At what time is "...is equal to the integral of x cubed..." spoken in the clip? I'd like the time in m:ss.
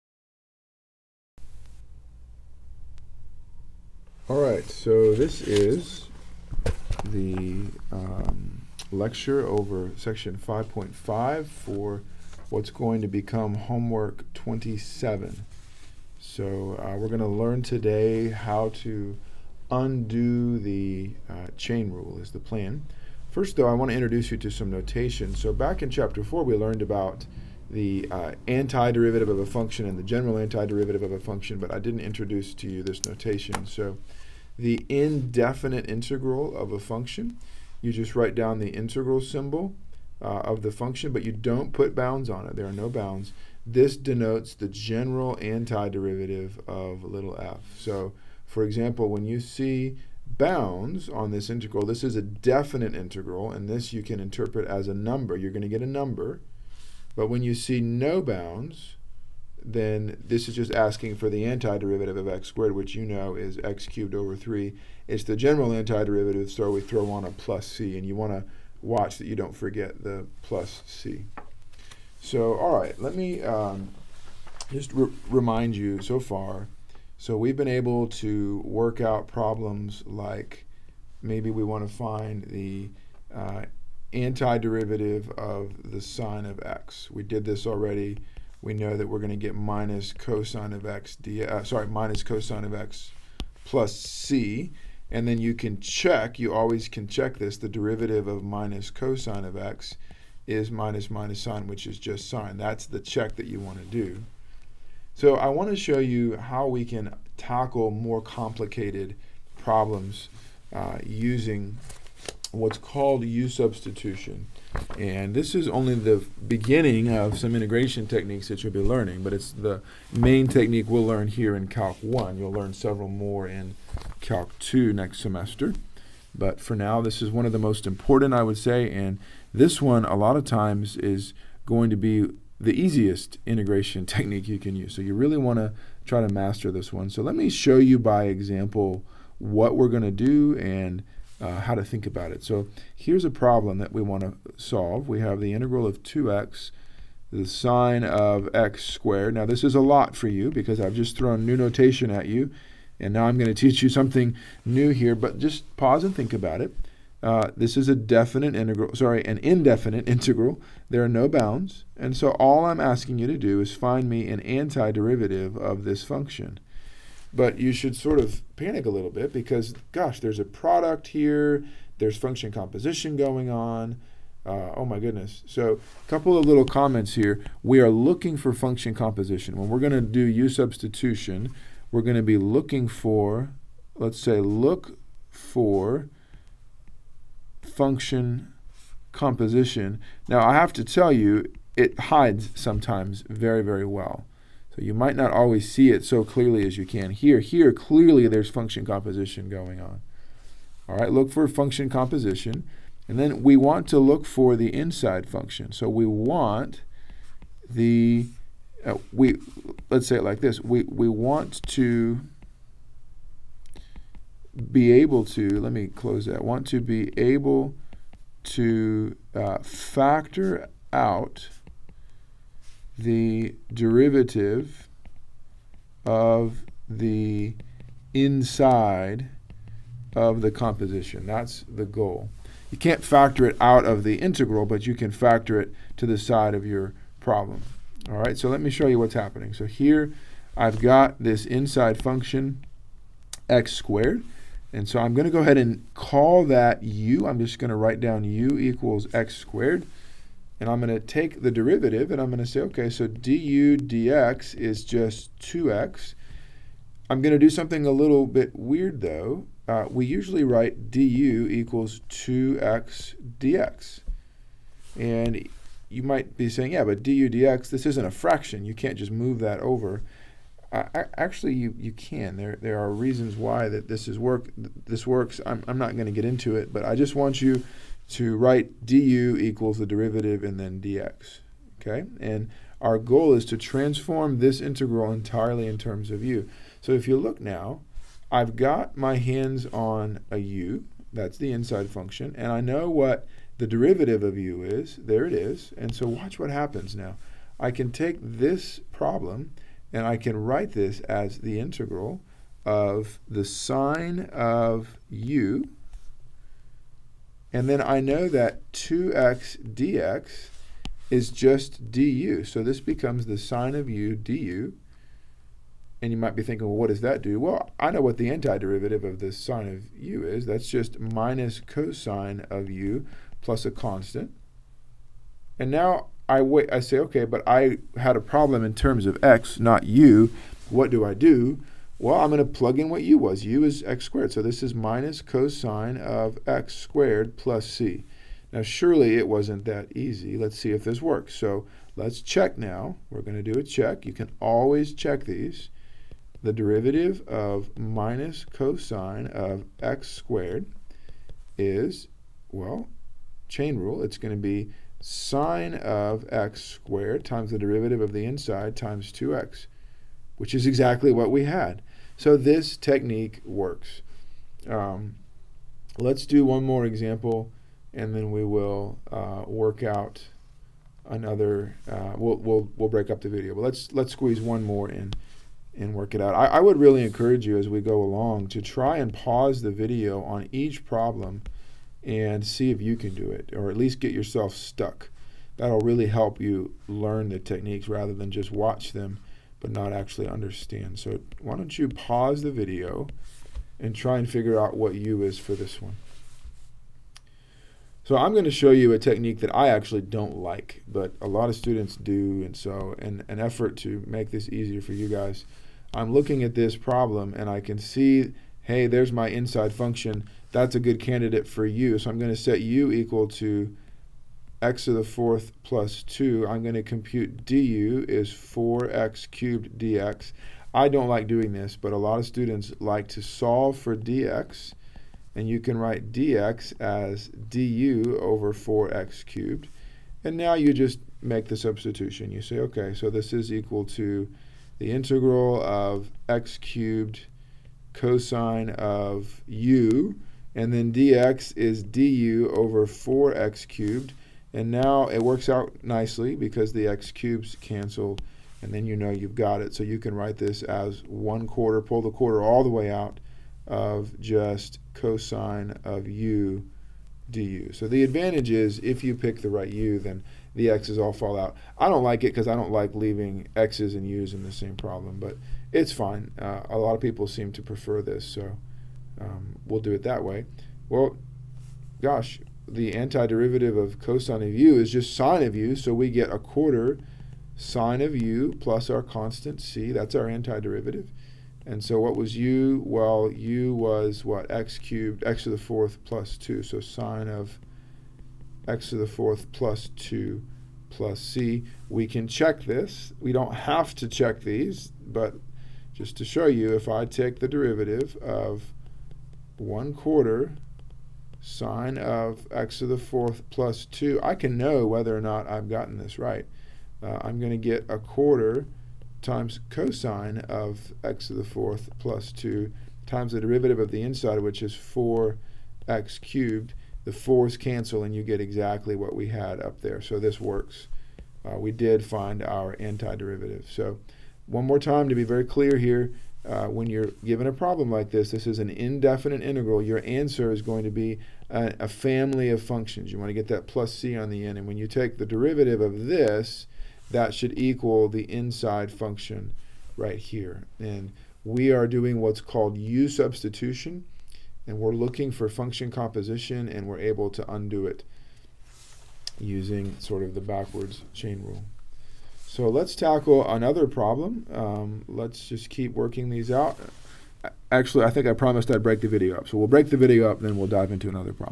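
7:13.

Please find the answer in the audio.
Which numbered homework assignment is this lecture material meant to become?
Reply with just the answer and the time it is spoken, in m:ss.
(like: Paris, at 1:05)
27, at 0:13.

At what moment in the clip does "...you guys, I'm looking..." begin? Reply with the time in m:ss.
6:44.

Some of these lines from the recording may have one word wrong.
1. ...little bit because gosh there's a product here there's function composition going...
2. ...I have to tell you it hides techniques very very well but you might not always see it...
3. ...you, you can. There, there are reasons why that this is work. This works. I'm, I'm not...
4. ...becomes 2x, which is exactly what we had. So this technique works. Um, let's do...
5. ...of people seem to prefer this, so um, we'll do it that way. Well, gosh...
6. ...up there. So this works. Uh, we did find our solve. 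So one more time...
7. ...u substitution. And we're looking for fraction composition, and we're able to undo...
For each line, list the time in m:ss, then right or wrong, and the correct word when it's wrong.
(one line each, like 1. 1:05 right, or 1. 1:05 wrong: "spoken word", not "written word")
1. 2:48 right
2. 3:10 wrong: "sometimes", not "techniques"
3. 4:31 right
4. 5:58 wrong: "times", not "becomes"
5. 7:46 right
6. 8:39 wrong: "antiderivative", not "solve"
7. 9:02 wrong: "function", not "fraction".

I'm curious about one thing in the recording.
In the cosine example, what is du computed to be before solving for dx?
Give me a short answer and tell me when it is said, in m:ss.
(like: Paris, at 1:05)
4x cubed dx, at 6:58.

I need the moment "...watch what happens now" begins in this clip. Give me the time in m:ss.
4:56.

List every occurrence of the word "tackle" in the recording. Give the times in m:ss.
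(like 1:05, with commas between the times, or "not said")
1:47, 9:12.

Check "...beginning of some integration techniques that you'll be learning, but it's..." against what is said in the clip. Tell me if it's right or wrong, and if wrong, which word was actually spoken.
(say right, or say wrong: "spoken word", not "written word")
right.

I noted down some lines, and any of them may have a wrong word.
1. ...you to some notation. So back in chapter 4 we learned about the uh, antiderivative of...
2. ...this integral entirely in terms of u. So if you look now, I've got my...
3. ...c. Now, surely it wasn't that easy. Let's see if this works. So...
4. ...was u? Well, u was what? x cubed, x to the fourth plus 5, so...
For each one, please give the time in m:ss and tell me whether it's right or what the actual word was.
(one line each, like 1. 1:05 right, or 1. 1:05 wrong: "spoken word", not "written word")
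1. 0:24 right
2. 4:44 right
3. 5:37 right
4. 8:02 wrong: "2", not "5".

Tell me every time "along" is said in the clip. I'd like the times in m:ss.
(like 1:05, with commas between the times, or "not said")
6:18.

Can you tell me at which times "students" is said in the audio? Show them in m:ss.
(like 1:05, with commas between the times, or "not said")
6:41, 7:02.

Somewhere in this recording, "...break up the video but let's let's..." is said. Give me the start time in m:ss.
6:12.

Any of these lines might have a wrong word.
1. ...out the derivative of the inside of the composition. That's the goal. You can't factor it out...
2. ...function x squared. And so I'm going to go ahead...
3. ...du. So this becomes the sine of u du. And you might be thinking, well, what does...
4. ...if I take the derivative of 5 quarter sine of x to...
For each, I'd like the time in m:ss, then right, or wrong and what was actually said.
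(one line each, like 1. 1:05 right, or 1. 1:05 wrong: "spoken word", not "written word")
1. 3:40 right
2. 4:02 right
3. 5:11 right
4. 8:16 wrong: "1", not "5".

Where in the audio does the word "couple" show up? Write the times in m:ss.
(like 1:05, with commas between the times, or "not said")
2:56.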